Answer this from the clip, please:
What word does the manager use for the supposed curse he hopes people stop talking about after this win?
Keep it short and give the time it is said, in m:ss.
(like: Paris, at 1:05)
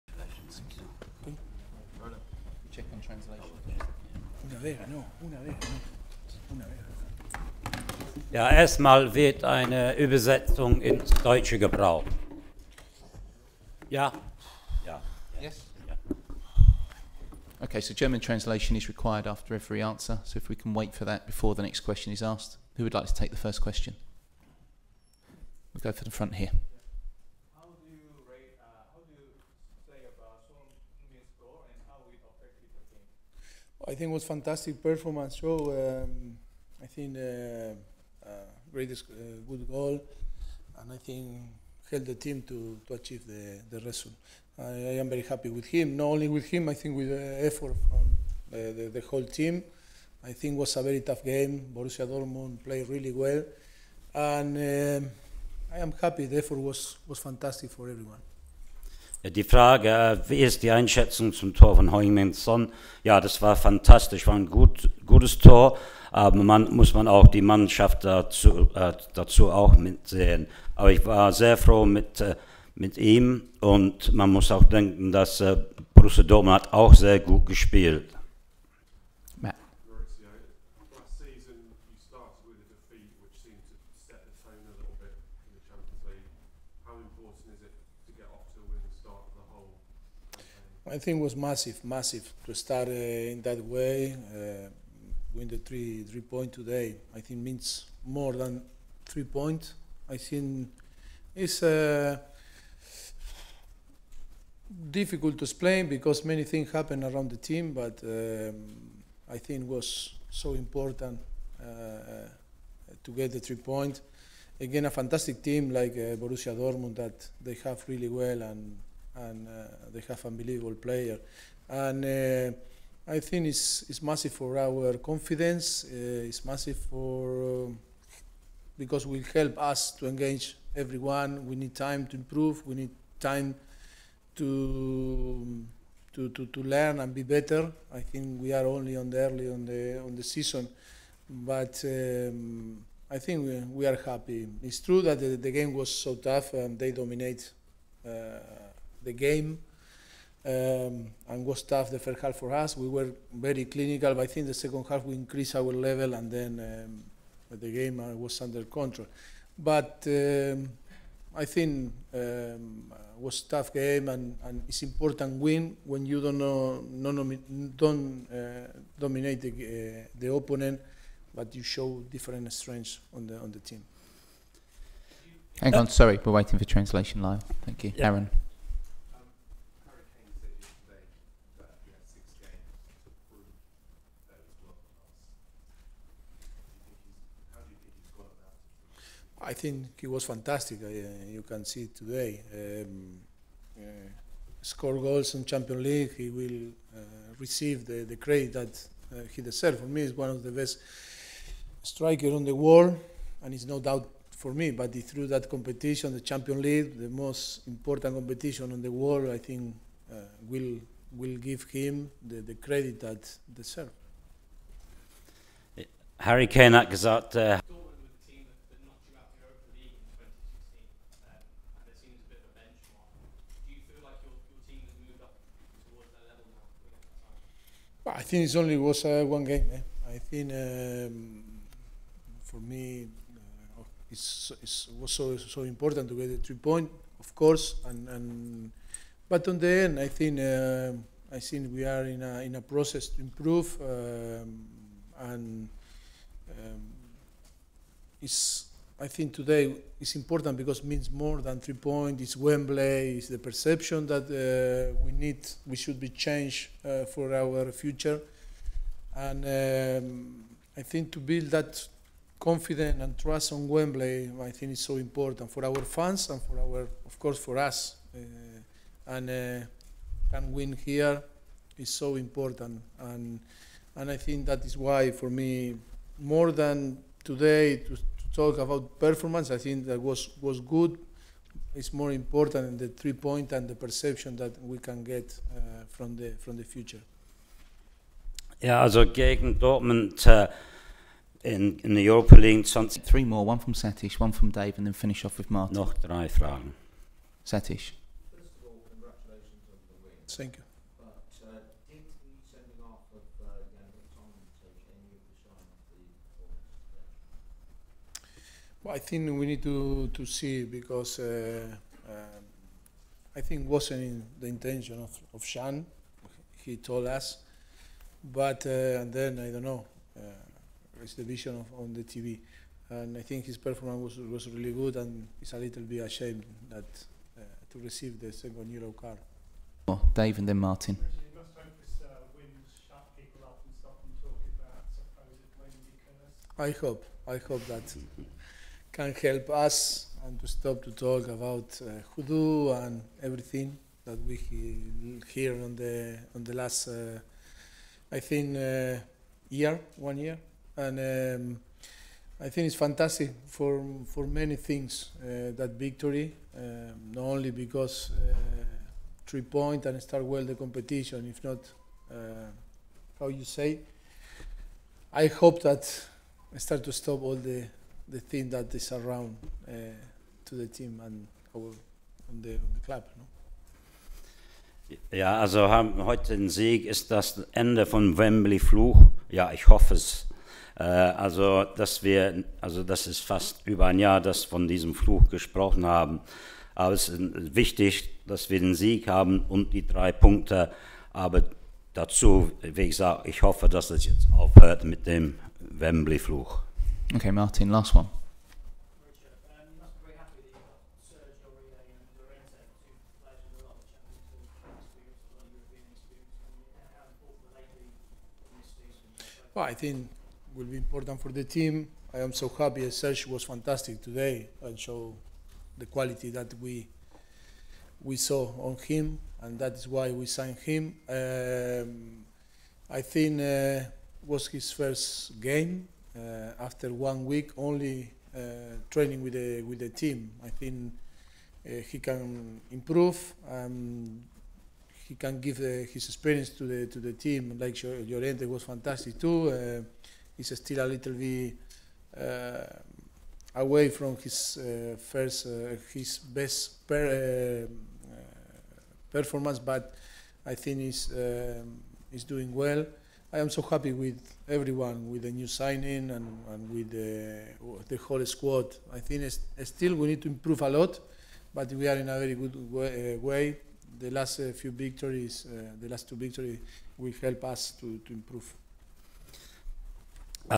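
hoodoo, at 5:42.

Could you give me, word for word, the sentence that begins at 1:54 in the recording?
Again, a fantastic team like uh, Borussia Dortmund that they have really well and and uh, they have unbelievable player.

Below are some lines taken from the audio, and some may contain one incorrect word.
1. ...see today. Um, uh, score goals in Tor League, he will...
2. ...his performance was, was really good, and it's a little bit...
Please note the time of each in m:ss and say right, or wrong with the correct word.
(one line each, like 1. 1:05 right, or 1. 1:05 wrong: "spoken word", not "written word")
1. 3:11 wrong: "Champions", not "Tor"
2. 5:23 right.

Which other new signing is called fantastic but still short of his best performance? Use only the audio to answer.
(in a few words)
Llorente.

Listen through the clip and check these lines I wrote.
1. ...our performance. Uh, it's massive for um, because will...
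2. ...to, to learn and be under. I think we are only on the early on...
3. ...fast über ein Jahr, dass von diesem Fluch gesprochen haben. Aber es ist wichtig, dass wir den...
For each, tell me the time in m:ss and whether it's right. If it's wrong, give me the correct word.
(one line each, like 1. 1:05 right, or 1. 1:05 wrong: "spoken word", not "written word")
1. 2:04 wrong: "confidence", not "performance"
2. 2:16 wrong: "better", not "under"
3. 6:23 right.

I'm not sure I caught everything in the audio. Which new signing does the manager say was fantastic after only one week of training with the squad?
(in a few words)
Serge.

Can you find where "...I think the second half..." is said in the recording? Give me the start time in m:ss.
2:34.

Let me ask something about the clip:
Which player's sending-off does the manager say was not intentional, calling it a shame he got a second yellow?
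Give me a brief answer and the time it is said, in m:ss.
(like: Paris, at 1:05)
Jan, at 5:15.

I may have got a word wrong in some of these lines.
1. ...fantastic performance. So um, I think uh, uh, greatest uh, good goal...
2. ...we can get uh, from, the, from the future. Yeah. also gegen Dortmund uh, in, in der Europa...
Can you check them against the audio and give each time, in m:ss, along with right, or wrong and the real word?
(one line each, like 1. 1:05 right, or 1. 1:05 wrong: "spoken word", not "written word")
1. 0:34 right
2. 4:44 right.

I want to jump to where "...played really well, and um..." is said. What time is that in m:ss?
0:52.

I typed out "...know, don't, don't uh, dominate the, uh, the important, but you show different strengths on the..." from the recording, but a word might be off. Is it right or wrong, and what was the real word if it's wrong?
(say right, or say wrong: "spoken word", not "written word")
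wrong: "opponent", not "important".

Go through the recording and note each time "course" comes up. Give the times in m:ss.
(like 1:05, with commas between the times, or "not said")
3:57, 4:27.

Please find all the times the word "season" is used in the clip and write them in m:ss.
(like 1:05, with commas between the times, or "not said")
2:20.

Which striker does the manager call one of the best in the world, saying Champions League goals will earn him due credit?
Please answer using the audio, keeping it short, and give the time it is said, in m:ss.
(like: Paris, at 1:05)
Harry Kane, at 3:36.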